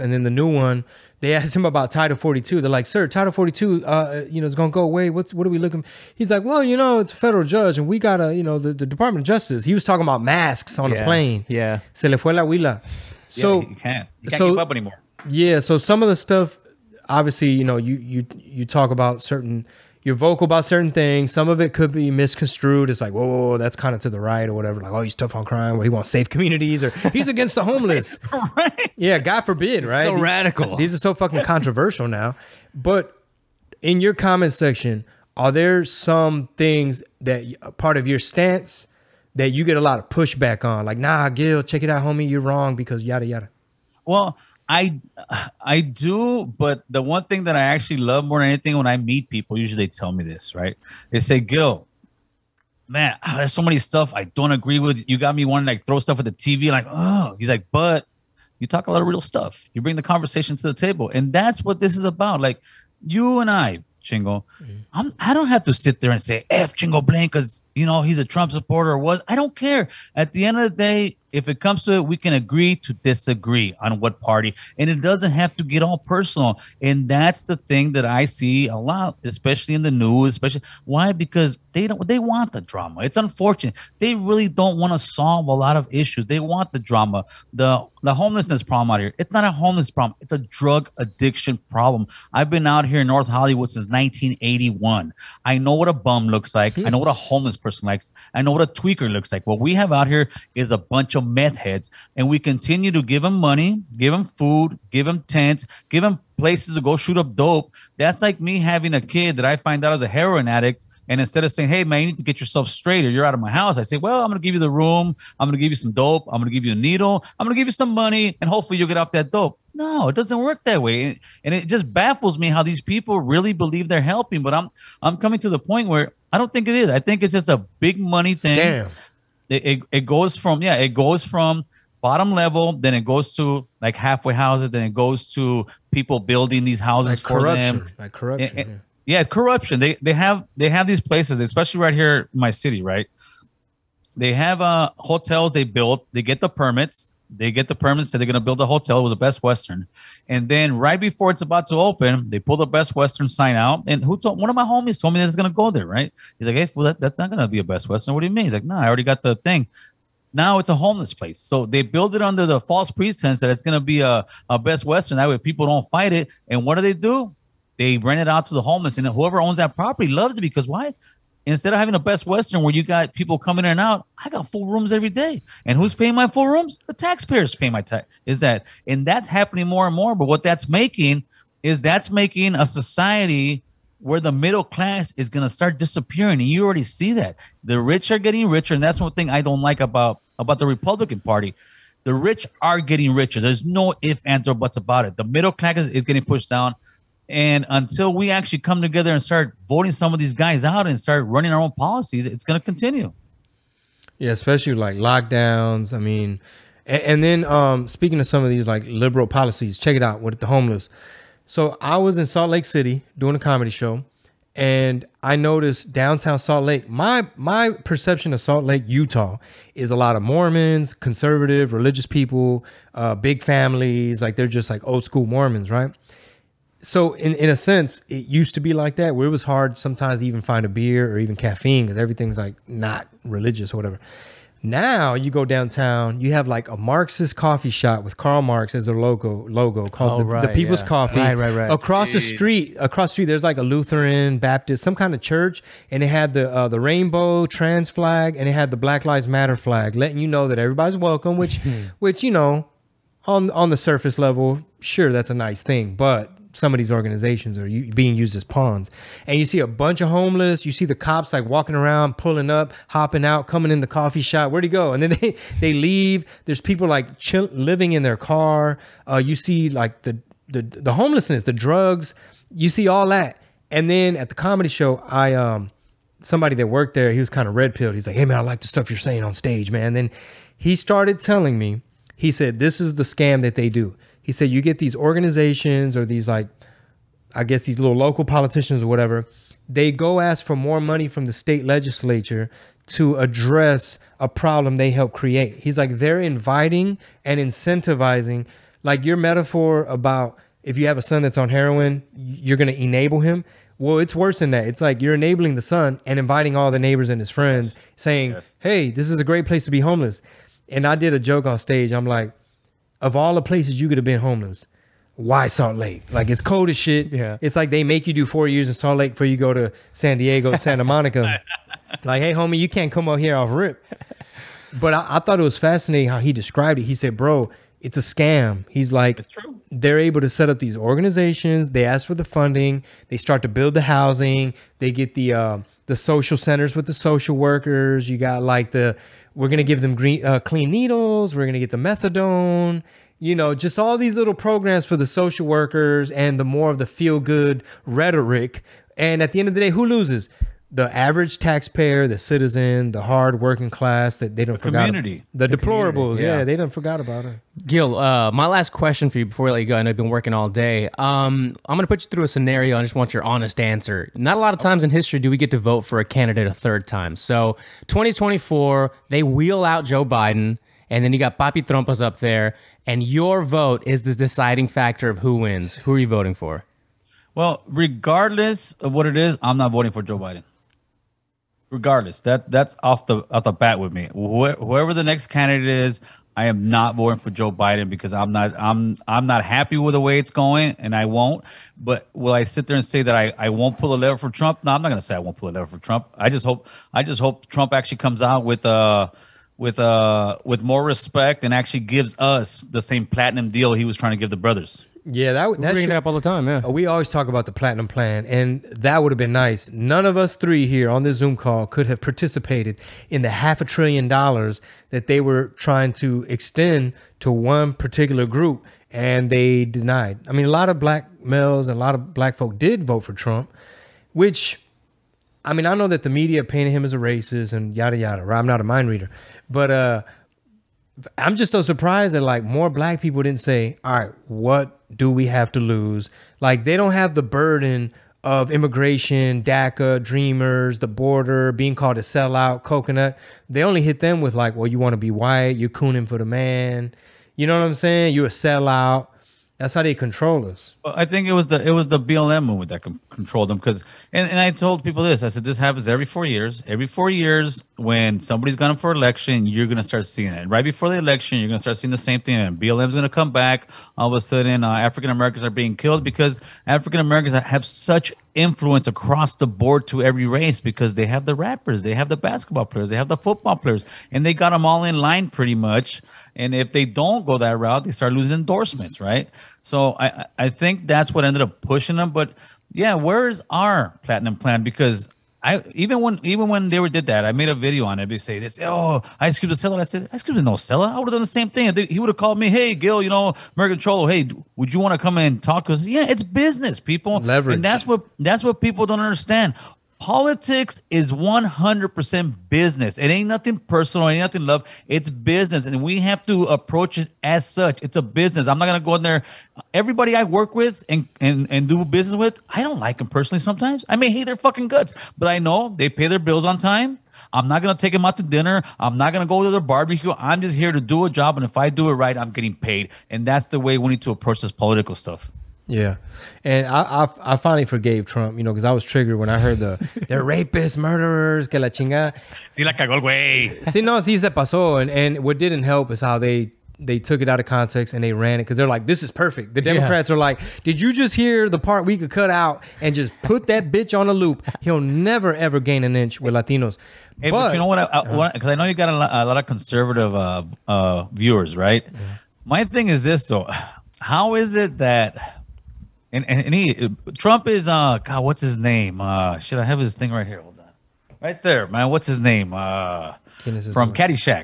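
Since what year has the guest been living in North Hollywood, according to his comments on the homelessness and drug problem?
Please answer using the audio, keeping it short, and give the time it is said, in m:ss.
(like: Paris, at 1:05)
1981, at 1:33.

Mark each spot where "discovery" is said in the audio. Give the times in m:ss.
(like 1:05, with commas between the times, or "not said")
not said.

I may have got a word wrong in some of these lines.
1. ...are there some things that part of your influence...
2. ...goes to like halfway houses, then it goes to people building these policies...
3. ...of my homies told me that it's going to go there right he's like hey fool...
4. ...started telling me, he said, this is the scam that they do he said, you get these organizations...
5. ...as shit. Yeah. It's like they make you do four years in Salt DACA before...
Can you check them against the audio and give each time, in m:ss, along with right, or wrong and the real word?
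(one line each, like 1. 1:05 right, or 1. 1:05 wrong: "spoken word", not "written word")
1. 0:35 wrong: "stance", not "influence"
2. 2:13 wrong: "houses", not "policies"
3. 2:34 right
4. 4:40 right
5. 5:16 wrong: "Lake", not "DACA".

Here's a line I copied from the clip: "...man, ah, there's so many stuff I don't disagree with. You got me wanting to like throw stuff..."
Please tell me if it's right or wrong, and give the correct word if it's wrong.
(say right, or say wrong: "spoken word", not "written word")
wrong: "agree", not "disagree".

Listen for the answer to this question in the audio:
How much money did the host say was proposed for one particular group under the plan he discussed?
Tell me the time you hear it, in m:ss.
6:53.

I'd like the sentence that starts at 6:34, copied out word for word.
No, I'm not going to say I won't pull a lever for Trump.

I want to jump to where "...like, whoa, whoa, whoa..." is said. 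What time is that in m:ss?
0:22.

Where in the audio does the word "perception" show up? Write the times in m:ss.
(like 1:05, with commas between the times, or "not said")
3:37.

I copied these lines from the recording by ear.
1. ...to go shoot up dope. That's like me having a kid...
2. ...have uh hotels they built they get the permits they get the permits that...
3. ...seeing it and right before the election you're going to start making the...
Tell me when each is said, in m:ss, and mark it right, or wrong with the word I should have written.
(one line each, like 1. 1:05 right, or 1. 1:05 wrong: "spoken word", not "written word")
1. 1:46 right
2. 2:24 right
3. 7:40 wrong: "seeing", not "making".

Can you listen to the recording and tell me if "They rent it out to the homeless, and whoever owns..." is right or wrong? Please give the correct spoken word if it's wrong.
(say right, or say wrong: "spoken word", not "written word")
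right.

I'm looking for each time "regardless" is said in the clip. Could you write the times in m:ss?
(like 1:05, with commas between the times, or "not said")
6:17, 6:21.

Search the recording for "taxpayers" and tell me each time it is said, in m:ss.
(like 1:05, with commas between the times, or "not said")
2:56, 5:51.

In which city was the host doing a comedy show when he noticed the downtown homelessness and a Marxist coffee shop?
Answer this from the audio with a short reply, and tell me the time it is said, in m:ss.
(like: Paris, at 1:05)
Salt Lake City, at 3:32.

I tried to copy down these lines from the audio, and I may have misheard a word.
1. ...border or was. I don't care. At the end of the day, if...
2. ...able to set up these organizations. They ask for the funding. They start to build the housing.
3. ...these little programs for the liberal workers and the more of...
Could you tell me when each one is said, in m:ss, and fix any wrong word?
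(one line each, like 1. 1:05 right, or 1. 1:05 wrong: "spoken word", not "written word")
1. 1:08 wrong: "supporter", not "border"
2. 5:29 right
3. 5:43 wrong: "social", not "liberal".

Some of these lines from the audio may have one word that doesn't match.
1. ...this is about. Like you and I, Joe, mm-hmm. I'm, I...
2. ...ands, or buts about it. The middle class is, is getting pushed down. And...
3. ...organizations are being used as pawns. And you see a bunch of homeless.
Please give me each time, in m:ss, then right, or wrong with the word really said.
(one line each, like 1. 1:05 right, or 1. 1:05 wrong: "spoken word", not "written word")
1. 1:01 wrong: "Chingo", not "Joe"
2. 3:14 right
3. 4:16 right.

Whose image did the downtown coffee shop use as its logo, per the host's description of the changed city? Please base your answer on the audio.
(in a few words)
Karl Marx.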